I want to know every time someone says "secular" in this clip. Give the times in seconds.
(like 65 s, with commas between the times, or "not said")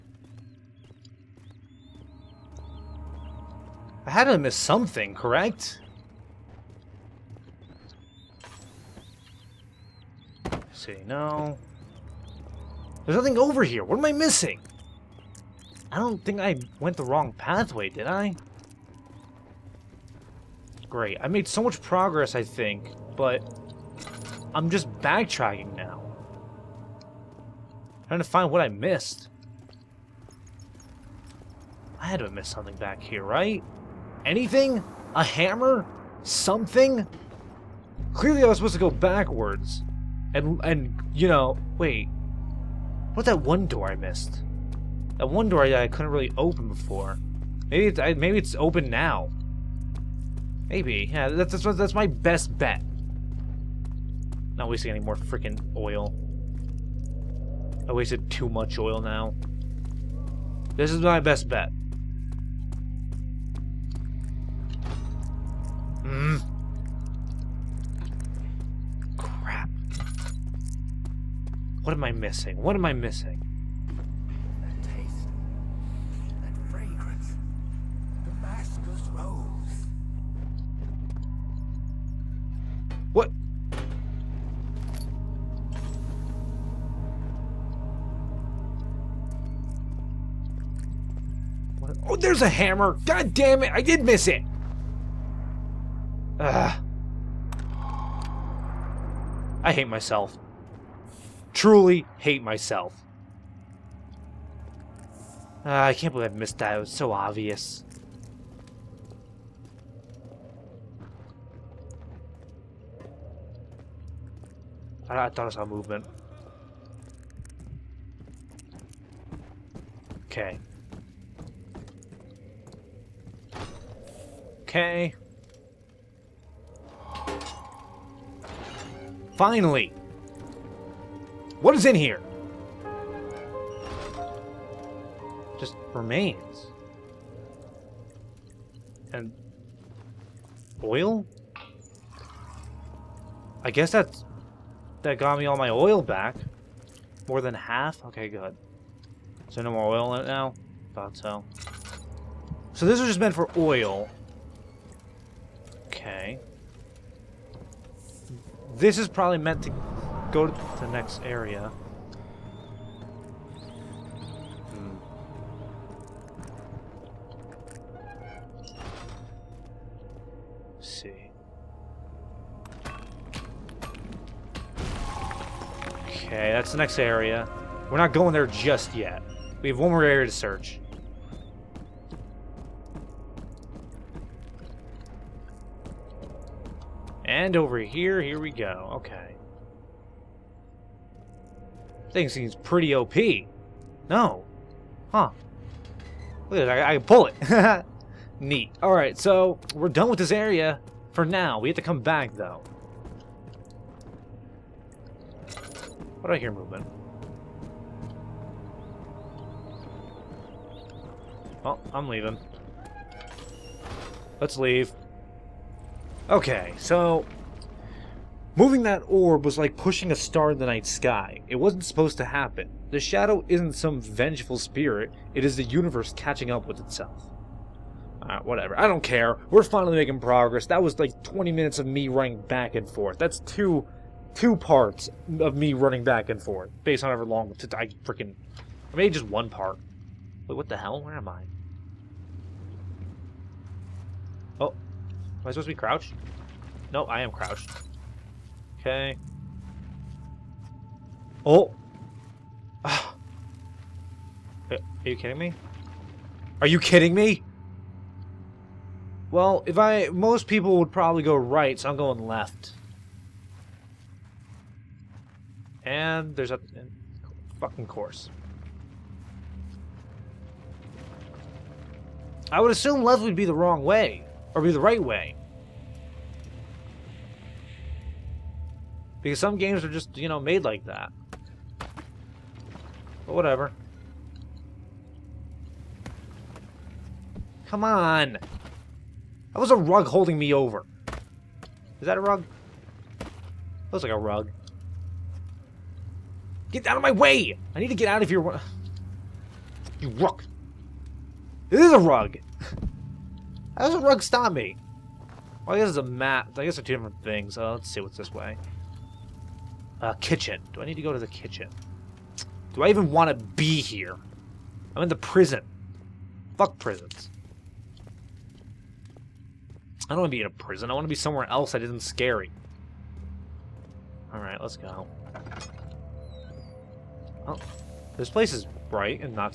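not said.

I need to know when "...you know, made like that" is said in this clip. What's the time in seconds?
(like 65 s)
280 s.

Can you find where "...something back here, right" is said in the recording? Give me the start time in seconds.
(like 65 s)
32 s.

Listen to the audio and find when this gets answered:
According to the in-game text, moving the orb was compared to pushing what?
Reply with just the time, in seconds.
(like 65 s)
219 s.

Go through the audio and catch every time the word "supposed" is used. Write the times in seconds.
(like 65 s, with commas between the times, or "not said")
38 s, 221 s, 245 s.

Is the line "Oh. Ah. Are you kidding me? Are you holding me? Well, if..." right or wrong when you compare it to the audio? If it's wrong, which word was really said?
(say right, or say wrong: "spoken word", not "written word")
wrong: "kidding", not "holding".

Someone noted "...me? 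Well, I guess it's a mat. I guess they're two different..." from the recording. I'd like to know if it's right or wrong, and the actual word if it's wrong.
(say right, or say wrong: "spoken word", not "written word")
right.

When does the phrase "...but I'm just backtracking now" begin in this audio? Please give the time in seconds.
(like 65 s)
23 s.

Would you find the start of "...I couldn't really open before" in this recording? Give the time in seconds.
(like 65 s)
45 s.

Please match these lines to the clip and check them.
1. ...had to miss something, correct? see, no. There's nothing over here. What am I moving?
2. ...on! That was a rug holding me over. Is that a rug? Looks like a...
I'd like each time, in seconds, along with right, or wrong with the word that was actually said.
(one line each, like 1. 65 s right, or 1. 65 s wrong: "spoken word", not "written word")
1. 4 s wrong: "missing", not "moving"
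2. 287 s right.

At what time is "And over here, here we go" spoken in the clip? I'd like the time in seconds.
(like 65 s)
187 s.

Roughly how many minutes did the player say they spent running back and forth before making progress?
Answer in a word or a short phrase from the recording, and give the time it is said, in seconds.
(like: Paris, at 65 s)
20, at 231 s.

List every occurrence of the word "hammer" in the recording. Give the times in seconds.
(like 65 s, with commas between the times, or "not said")
35 s, 92 s.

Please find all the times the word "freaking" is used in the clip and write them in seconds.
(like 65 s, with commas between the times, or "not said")
55 s, 238 s.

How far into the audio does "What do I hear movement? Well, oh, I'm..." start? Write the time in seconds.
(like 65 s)
206 s.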